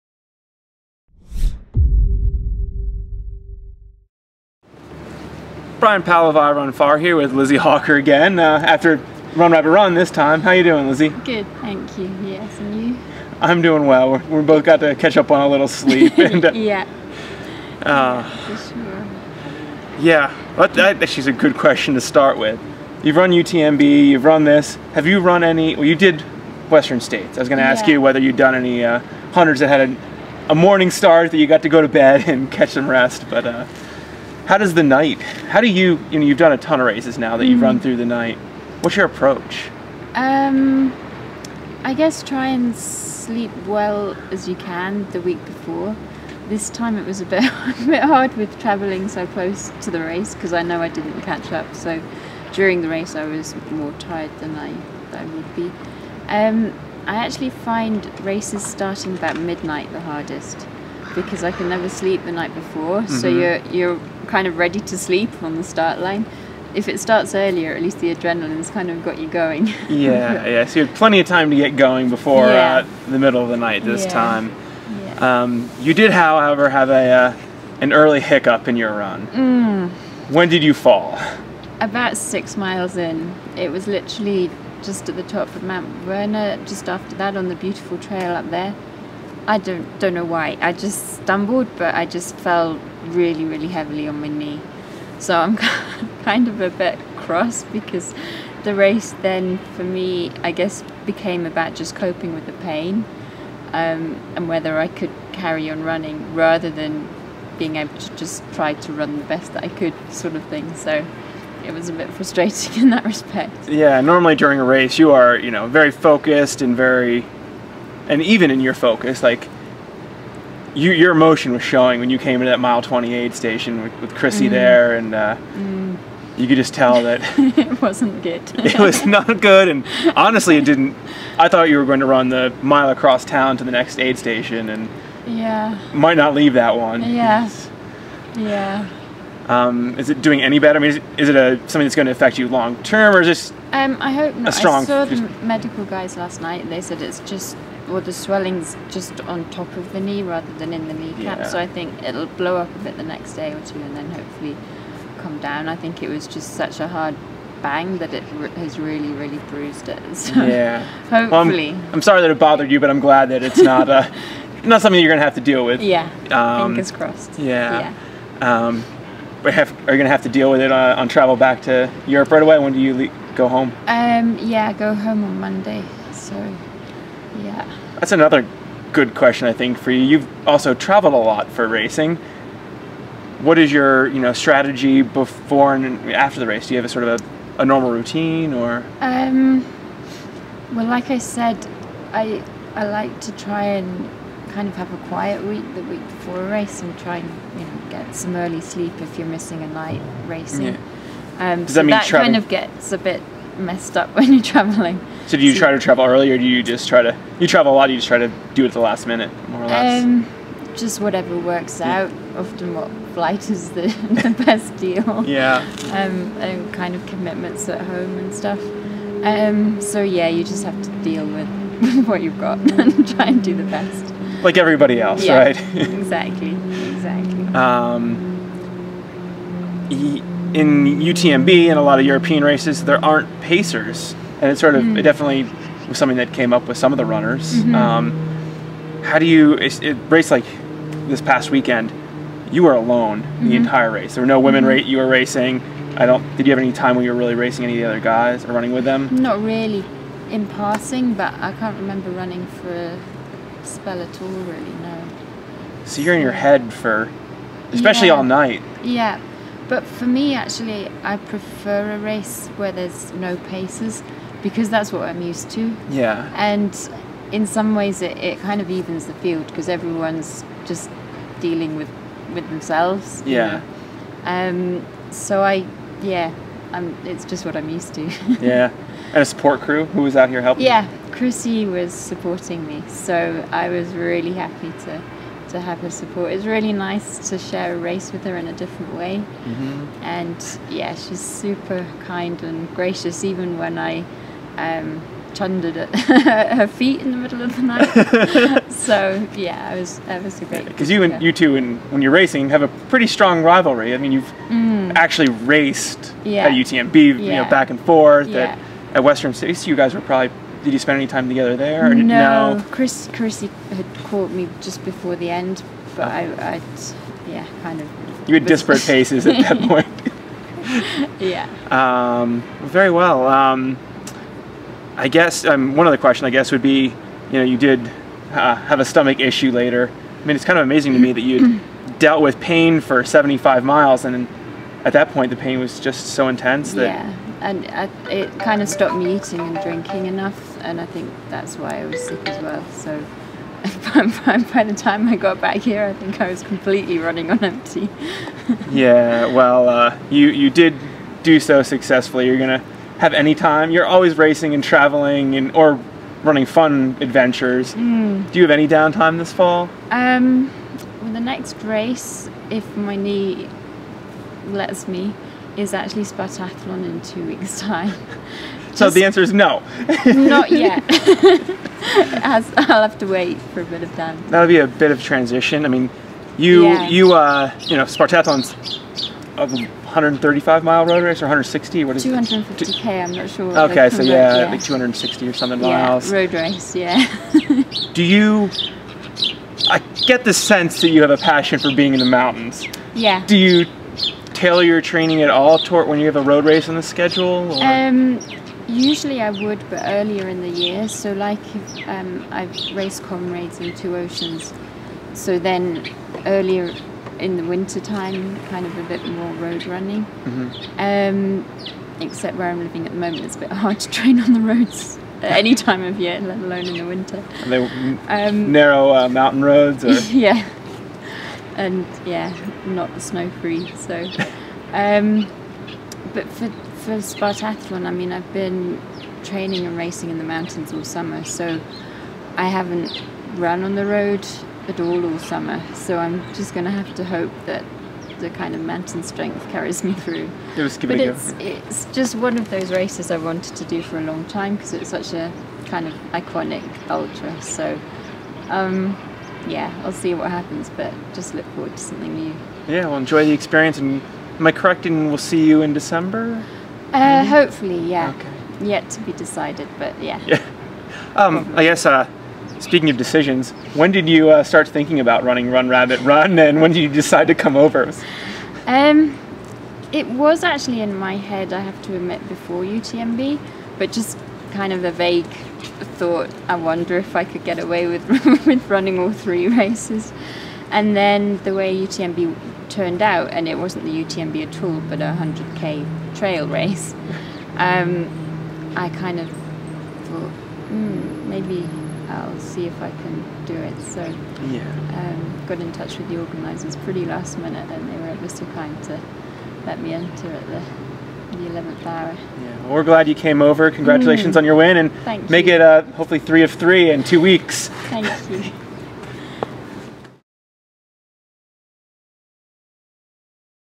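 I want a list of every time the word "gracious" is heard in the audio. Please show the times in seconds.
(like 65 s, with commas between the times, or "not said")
292 s.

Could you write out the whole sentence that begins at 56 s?
Um, I actually find races starting about midnight the hardest because I can never sleep the night before.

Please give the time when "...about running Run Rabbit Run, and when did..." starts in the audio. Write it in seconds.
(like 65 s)
465 s.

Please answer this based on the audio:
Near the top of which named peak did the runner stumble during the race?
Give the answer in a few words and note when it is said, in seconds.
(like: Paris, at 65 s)
Mount Werner, at 85 s.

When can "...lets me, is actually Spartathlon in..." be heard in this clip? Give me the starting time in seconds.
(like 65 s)
364 s.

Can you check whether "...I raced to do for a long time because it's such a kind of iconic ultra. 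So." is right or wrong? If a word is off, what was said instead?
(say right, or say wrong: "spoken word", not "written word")
wrong: "wanted", not "raced".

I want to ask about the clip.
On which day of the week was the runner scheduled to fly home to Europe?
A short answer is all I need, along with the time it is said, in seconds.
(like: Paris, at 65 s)
Monday, at 175 s.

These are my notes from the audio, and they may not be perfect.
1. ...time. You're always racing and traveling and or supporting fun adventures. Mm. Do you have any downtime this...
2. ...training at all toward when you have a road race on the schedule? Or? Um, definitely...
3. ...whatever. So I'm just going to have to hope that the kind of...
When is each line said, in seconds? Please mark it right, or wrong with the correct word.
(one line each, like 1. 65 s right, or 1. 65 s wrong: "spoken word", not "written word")
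1. 353 s wrong: "running", not "supporting"
2. 394 s wrong: "usually", not "definitely"
3. 435 s wrong: "summer", not "whatever".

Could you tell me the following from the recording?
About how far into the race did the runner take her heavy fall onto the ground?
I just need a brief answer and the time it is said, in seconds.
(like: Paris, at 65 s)
6 miles, at 82 s.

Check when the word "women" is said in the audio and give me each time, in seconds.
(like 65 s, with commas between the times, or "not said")
244 s.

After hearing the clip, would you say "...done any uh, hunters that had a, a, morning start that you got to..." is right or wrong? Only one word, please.
right.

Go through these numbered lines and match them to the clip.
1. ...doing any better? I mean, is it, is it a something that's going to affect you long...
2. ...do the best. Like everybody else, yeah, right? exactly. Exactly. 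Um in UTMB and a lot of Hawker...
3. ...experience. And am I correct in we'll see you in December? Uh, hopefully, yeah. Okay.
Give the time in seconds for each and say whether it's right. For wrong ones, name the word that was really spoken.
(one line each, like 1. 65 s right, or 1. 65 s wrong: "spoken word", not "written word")
1. 140 s right
2. 223 s wrong: "European", not "Hawker"
3. 453 s right.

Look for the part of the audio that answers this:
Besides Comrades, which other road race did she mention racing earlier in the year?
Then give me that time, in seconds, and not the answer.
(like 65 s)
403 s.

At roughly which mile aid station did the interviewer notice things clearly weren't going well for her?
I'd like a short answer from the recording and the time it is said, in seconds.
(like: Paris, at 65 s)
28, at 122 s.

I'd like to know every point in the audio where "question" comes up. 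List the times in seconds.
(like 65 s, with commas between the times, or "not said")
21 s, 179 s, 325 s.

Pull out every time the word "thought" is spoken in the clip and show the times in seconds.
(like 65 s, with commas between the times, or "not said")
131 s, 475 s, 489 s.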